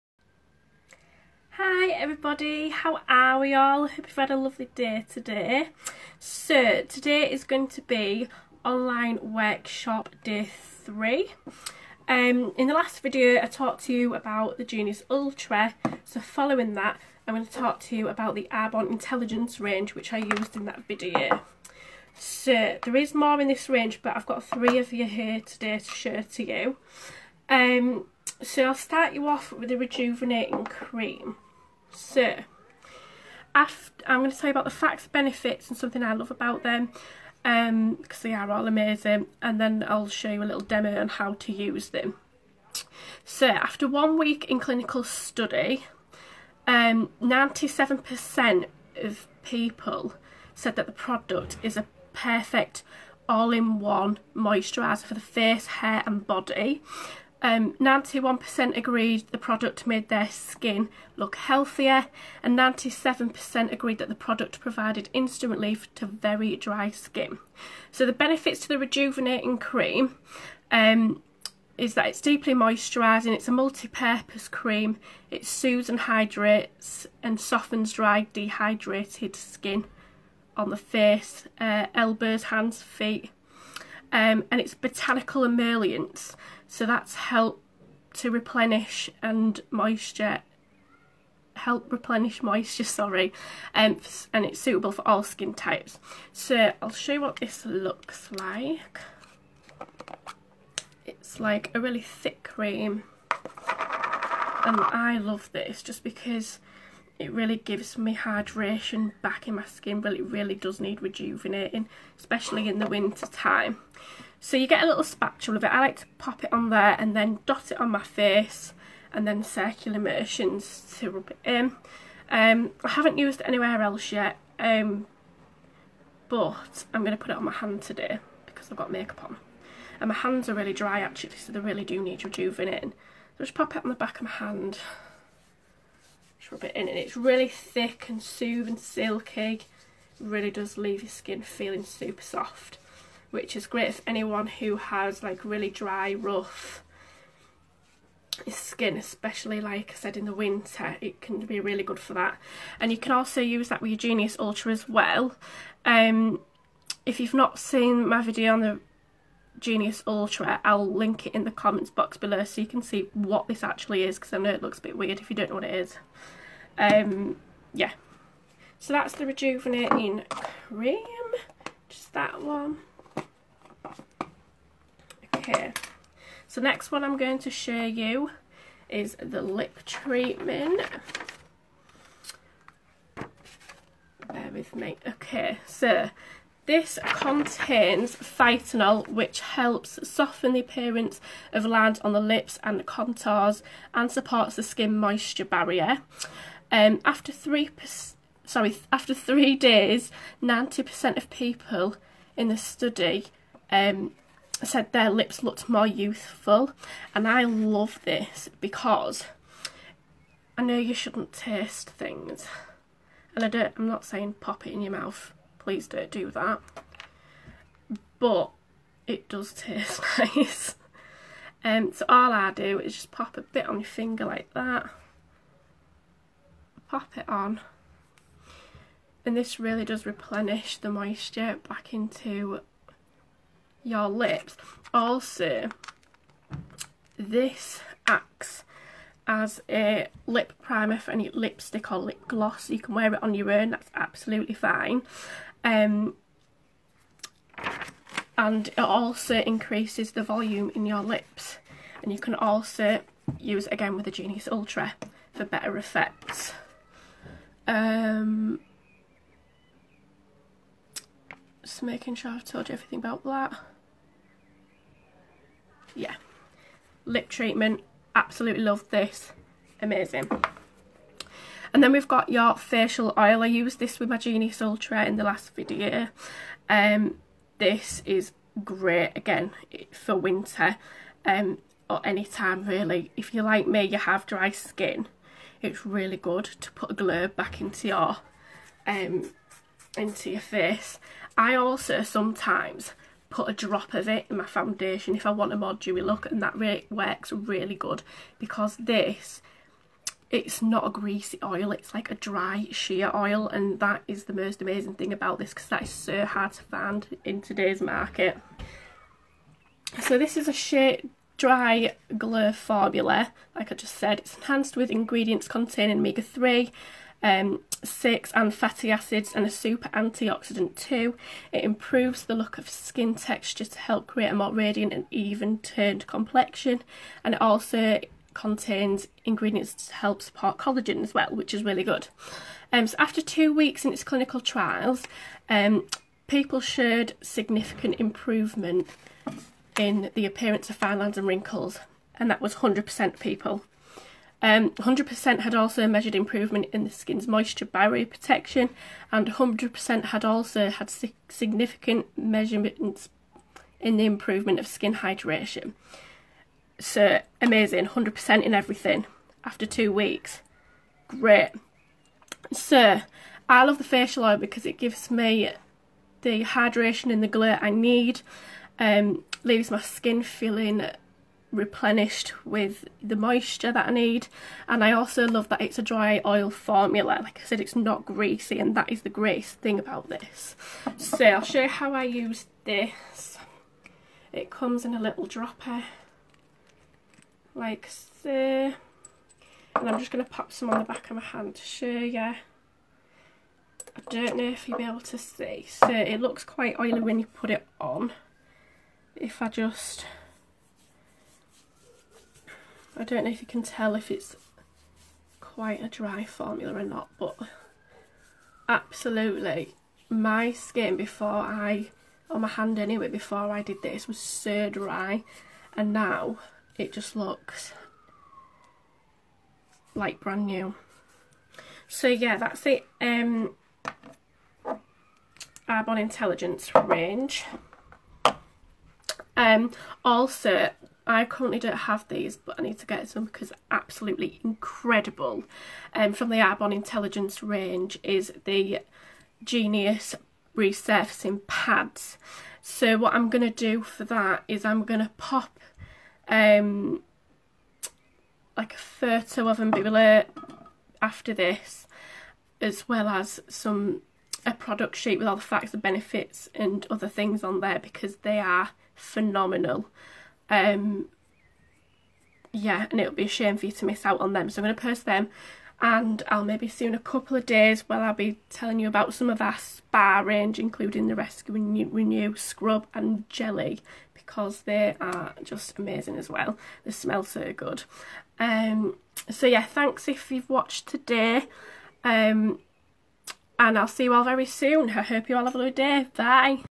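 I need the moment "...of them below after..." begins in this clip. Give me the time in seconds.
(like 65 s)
449 s.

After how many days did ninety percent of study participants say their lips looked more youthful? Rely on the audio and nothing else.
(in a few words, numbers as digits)
3.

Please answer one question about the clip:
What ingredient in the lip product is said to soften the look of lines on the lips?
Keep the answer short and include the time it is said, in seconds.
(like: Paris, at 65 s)
Phytonol, at 188 s.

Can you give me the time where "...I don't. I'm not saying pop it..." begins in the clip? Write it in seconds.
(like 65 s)
213 s.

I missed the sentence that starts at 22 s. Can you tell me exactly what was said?
So there is more in this range but I've got three of you here today to share to you.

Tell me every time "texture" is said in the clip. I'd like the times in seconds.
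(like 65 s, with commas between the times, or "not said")
323 s.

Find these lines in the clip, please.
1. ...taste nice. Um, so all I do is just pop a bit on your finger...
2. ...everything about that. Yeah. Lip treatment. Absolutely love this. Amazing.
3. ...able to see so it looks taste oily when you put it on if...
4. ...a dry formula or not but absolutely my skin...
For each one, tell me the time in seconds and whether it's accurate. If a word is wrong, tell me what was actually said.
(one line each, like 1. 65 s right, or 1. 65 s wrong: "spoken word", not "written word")
1. 219 s right
2. 262 s right
3. 394 s wrong: "quite", not "taste"
4. 405 s right.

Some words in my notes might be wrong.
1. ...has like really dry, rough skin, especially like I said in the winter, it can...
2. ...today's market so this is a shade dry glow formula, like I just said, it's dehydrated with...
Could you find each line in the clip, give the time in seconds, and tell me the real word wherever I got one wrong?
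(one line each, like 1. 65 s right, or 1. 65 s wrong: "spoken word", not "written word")
1. 144 s right
2. 307 s wrong: "enhanced", not "dehydrated".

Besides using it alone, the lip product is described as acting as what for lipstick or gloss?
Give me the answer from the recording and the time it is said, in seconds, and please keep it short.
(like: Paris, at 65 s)
Lip primer, at 240 s.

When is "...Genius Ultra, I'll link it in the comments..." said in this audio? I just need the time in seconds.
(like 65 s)
159 s.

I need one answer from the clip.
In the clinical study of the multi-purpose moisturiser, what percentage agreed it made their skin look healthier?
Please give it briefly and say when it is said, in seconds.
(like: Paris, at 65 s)
91%, at 57 s.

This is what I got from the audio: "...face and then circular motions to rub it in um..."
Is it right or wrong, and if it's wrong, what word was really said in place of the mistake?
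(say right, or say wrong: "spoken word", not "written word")
right.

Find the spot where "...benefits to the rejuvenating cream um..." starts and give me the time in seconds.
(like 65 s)
68 s.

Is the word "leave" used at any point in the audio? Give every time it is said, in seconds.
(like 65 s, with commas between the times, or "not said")
140 s, 369 s.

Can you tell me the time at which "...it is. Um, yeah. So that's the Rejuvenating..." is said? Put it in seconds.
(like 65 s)
165 s.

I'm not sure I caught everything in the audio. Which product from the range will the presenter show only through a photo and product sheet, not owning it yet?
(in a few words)
Genius Resurfacing Pads.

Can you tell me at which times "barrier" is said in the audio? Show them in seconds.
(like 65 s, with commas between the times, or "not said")
195 s, 347 s.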